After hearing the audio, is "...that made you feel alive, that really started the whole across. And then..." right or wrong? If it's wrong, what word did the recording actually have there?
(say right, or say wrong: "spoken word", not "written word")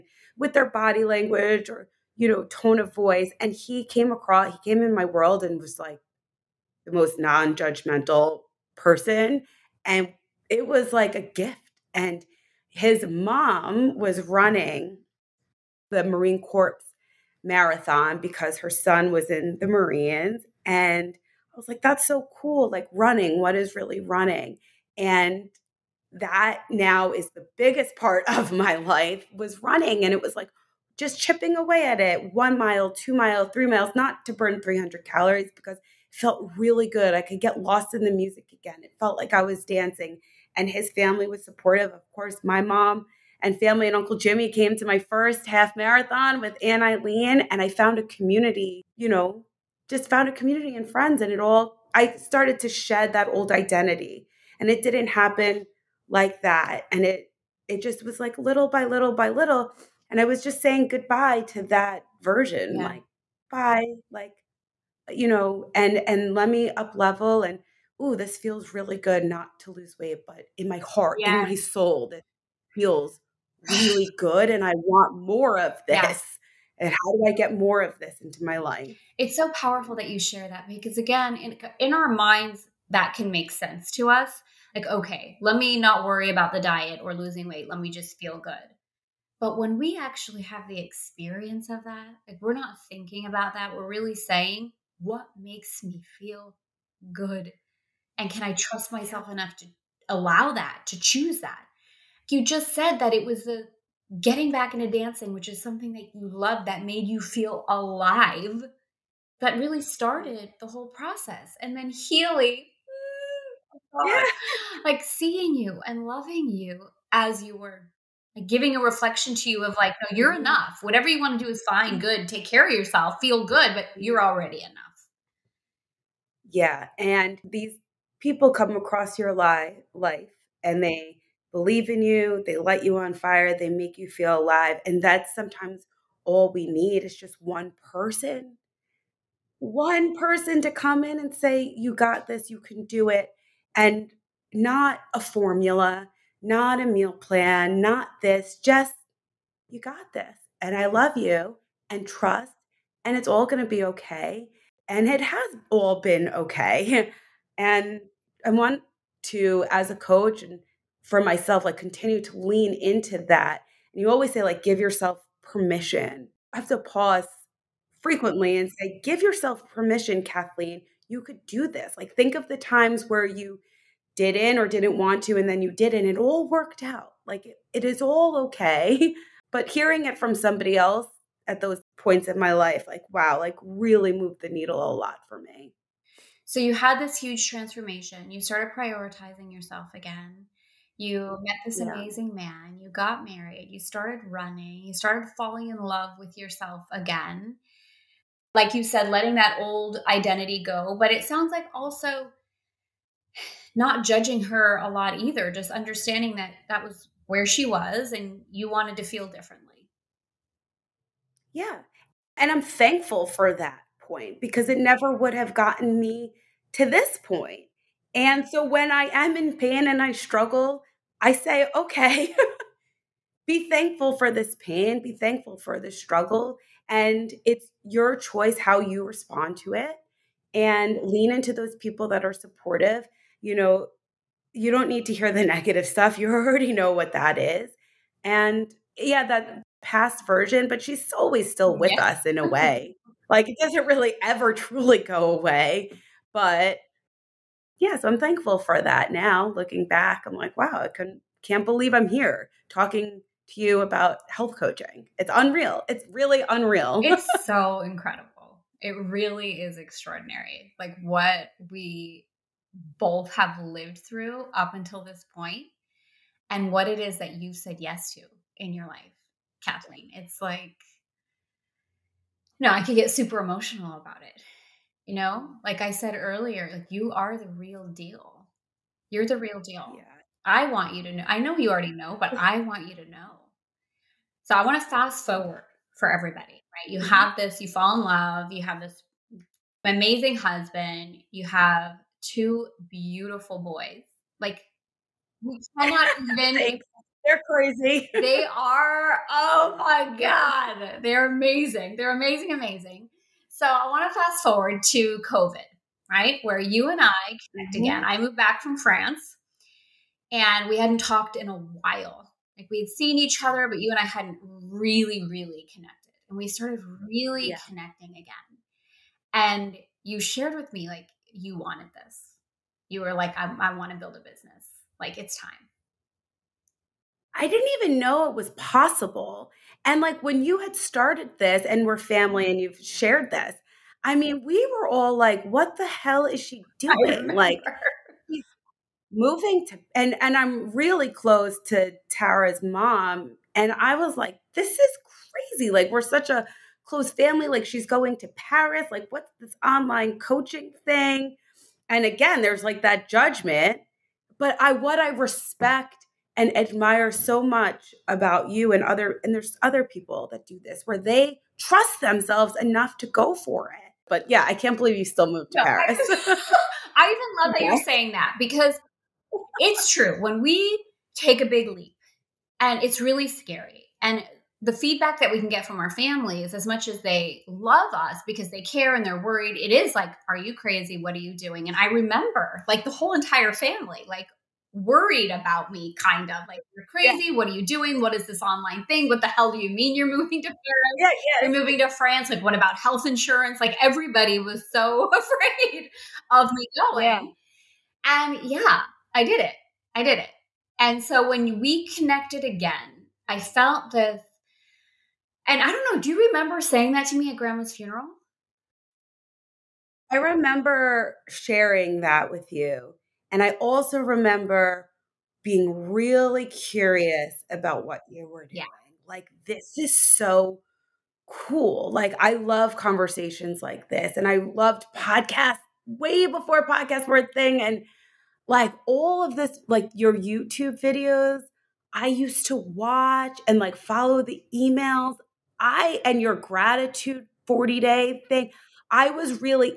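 wrong: "process", not "across".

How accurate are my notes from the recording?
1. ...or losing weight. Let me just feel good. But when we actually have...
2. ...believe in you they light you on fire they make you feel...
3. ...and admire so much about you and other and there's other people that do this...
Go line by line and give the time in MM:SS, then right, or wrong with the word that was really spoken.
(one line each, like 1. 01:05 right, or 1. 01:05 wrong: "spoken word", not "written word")
1. 01:27 right
2. 02:11 right
3. 05:56 right.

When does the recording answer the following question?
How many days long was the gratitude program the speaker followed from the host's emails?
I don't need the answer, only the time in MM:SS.
07:17.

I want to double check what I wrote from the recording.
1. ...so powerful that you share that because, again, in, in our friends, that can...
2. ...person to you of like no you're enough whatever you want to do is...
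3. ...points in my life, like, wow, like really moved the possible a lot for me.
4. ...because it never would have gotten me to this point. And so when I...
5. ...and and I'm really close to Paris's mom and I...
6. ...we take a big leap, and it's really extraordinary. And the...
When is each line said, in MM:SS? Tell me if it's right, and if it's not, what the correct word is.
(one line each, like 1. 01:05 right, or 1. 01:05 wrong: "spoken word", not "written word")
1. 01:19 wrong: "minds", not "friends"
2. 01:58 wrong: "reflection", not "person"
3. 03:01 wrong: "needle", not "possible"
4. 03:34 right
5. 05:39 wrong: "Tara", not "Paris"
6. 06:10 wrong: "scary", not "extraordinary".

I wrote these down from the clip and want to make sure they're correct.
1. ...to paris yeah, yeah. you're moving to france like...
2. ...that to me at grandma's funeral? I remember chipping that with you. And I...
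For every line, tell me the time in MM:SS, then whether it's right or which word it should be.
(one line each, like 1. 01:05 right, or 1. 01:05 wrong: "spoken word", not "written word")
1. 06:30 right
2. 06:46 wrong: "sharing", not "chipping".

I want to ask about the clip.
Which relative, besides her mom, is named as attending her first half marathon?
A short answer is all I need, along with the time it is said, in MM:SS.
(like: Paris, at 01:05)
Uncle Jimmy, at 00:43.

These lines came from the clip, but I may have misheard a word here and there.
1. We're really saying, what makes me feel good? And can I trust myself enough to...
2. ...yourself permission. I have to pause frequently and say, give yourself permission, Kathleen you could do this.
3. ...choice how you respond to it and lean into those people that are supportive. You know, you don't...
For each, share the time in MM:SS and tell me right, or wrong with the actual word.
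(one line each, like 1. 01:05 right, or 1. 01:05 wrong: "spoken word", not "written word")
1. 01:33 right
2. 02:44 right
3. 03:48 right.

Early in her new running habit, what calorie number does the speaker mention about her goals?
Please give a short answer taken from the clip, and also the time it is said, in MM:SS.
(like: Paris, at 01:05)
300, at 00:34.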